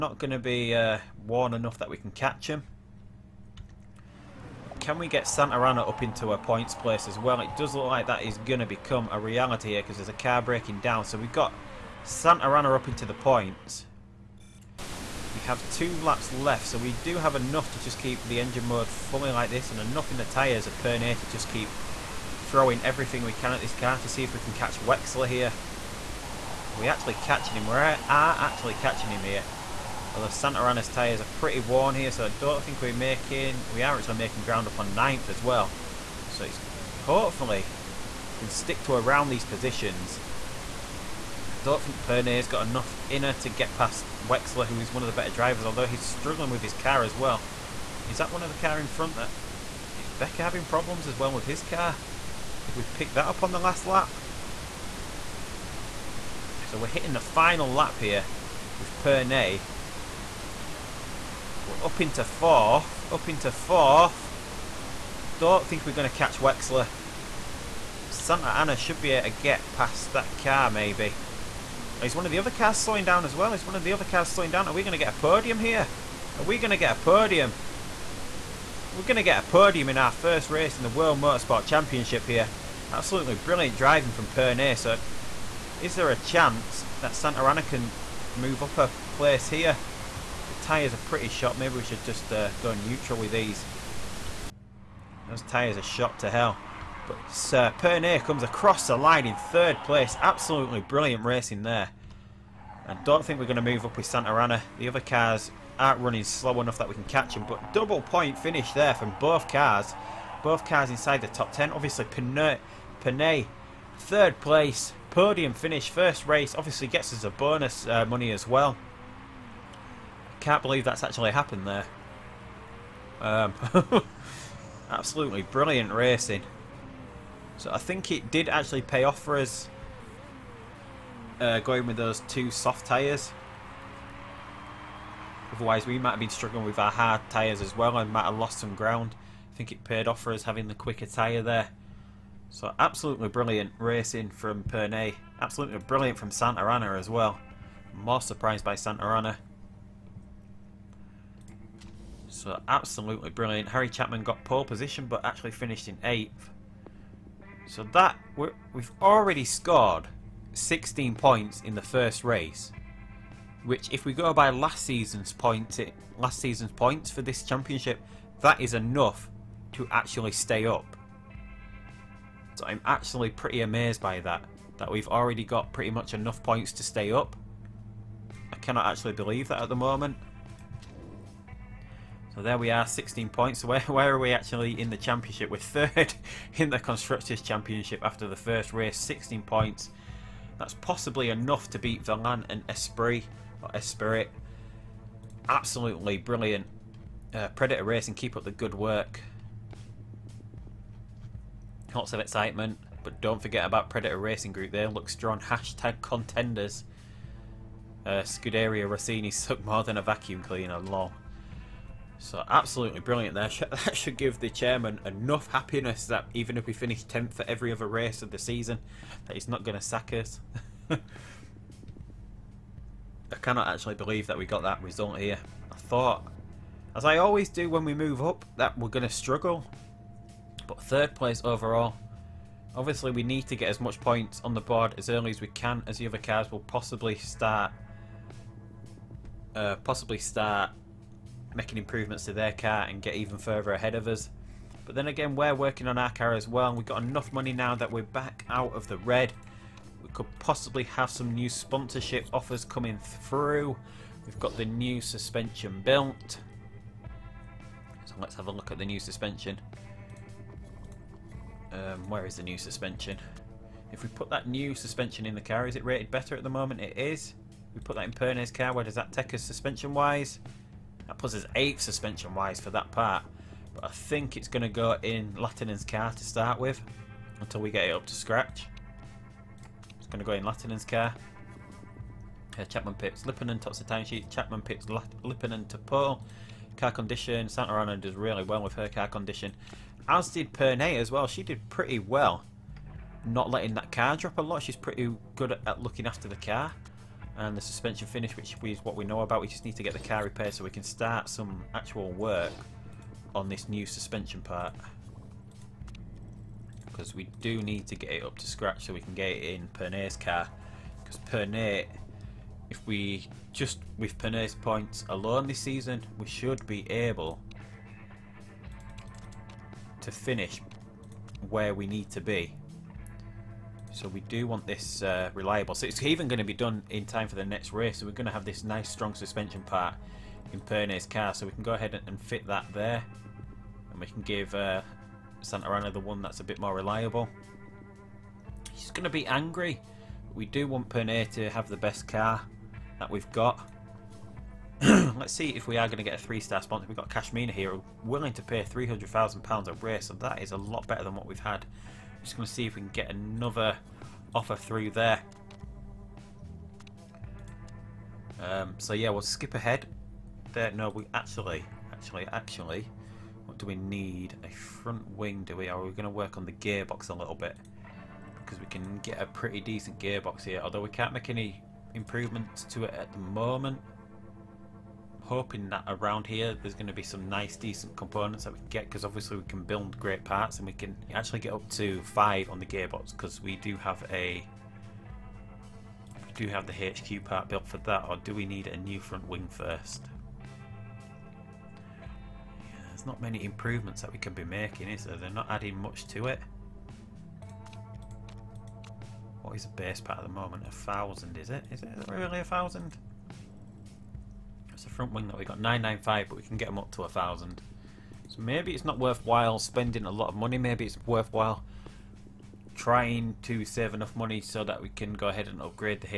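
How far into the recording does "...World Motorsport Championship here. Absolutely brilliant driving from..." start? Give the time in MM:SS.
01:20.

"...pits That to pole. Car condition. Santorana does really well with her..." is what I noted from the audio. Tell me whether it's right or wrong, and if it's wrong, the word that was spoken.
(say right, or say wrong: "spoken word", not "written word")
wrong: "Lippinen", not "That".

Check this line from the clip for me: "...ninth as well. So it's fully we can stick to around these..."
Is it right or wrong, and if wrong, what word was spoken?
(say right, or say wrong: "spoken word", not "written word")
wrong: "hopefully", not "fully".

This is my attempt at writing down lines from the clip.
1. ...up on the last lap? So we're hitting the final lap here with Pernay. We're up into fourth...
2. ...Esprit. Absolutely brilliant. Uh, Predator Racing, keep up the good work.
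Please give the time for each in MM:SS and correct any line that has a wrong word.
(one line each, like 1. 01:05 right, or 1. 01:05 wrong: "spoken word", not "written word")
1. 00:53 right
2. 03:13 right.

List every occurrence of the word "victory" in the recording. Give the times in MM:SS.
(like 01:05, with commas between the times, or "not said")
not said.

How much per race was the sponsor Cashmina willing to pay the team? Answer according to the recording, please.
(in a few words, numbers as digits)
£300,000.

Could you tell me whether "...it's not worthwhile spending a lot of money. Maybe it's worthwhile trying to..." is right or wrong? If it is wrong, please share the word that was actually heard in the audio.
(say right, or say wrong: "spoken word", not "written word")
right.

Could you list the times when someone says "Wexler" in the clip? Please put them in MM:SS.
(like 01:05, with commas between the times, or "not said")
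00:24, 00:44, 01:06.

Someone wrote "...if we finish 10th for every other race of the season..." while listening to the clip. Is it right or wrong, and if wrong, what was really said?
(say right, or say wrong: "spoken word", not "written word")
right.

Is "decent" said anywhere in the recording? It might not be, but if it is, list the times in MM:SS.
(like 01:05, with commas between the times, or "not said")
06:09, 06:17.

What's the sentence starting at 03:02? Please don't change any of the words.
So there we are, 16 points.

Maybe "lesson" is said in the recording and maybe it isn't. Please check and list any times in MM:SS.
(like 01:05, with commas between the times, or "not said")
not said.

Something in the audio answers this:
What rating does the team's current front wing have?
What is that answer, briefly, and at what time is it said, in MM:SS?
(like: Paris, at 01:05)
995, at 06:45.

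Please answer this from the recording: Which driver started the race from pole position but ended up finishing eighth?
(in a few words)
Harry Chapman.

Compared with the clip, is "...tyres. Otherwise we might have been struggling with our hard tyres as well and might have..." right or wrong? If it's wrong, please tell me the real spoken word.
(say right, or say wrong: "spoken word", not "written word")
right.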